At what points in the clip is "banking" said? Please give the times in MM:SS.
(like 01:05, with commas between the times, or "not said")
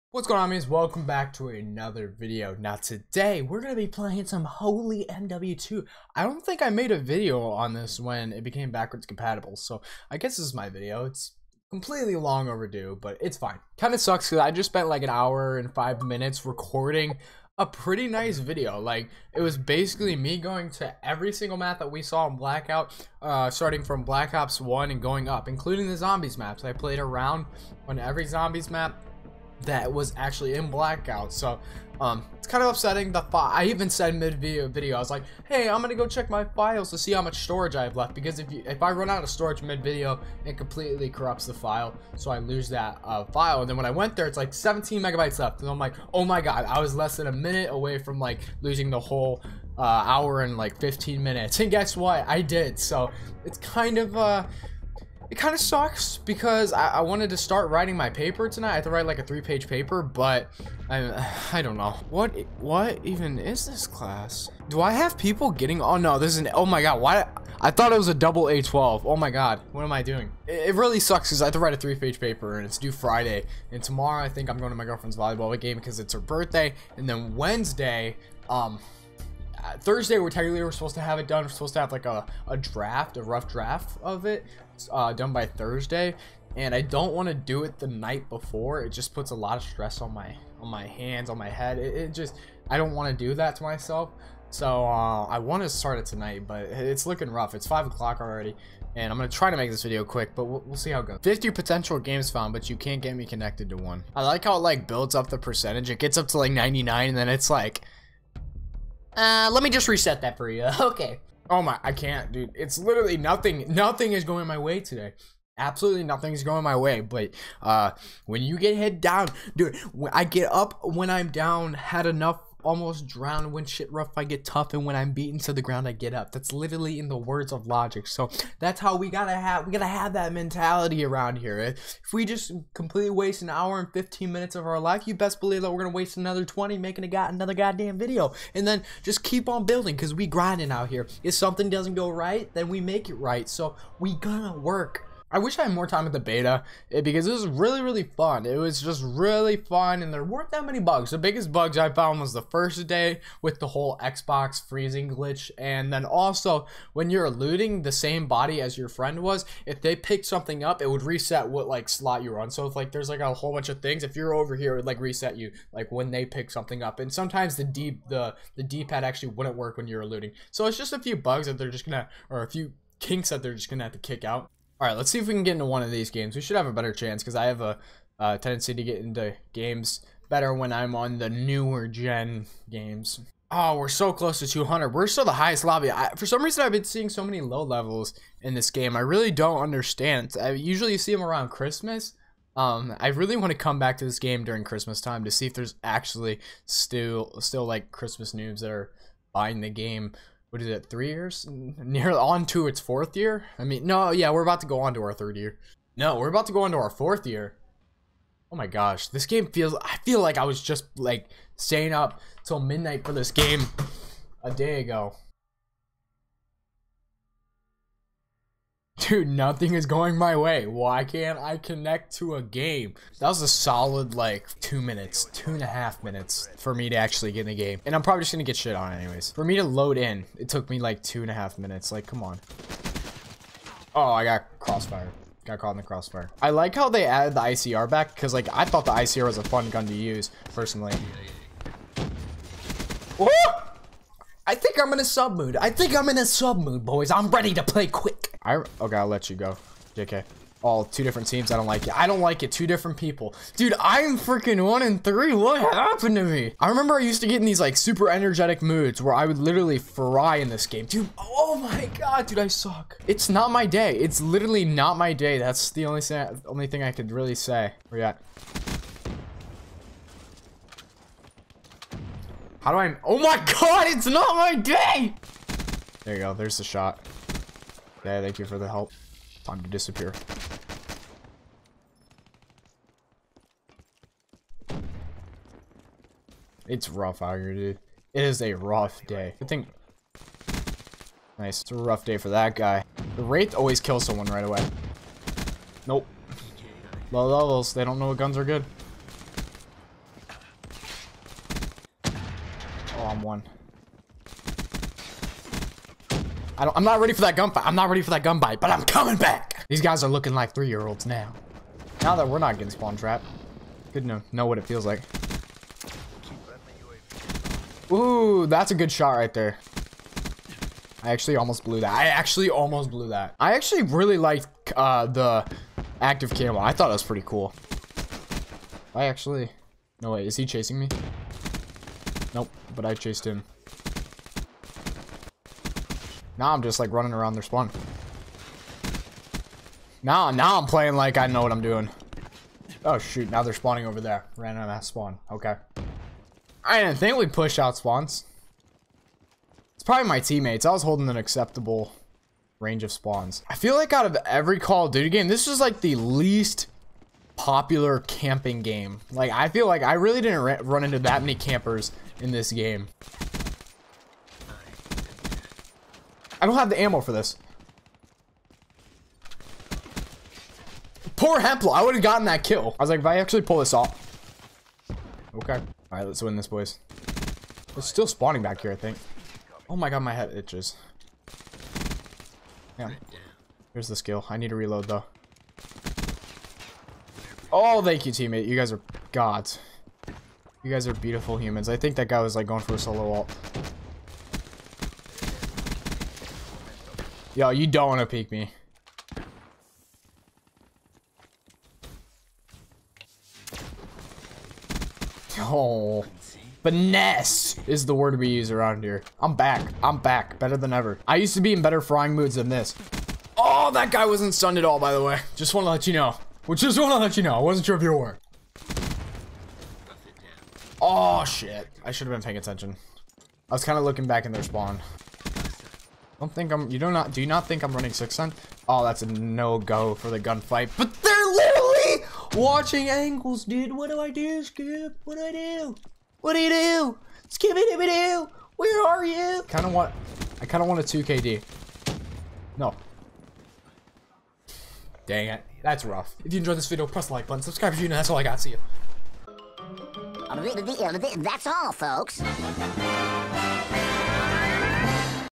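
not said.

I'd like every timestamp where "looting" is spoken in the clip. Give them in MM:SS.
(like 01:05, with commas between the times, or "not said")
02:37, 02:50.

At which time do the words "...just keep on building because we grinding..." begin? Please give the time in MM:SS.
02:19.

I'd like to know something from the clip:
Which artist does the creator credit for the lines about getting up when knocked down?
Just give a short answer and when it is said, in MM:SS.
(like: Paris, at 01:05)
Logic, at 02:07.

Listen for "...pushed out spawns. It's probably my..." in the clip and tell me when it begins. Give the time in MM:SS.
05:47.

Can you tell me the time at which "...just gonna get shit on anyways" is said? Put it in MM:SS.
03:48.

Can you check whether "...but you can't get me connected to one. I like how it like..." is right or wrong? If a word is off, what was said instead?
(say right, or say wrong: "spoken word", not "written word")
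right.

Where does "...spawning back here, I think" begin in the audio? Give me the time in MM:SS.
06:18.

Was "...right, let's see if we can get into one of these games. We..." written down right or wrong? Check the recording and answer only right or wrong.
right.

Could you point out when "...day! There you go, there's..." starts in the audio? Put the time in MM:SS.
04:34.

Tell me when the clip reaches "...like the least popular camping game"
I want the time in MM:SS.
05:55.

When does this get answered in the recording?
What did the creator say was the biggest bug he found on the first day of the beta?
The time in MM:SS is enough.
02:34.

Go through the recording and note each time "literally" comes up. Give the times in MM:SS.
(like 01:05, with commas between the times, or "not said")
01:52, 02:06, 04:19, 04:24, 07:11.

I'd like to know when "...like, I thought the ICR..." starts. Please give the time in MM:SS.
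03:58.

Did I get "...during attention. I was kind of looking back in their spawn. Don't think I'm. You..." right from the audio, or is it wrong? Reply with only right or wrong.
wrong.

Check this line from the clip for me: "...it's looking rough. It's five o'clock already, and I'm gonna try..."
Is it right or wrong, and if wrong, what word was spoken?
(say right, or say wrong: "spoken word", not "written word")
right.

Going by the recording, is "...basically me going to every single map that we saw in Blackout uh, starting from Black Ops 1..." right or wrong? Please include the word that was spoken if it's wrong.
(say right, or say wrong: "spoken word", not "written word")
right.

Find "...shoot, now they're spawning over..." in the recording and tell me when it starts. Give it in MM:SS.
05:42.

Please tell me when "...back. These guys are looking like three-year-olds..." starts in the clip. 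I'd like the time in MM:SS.
05:09.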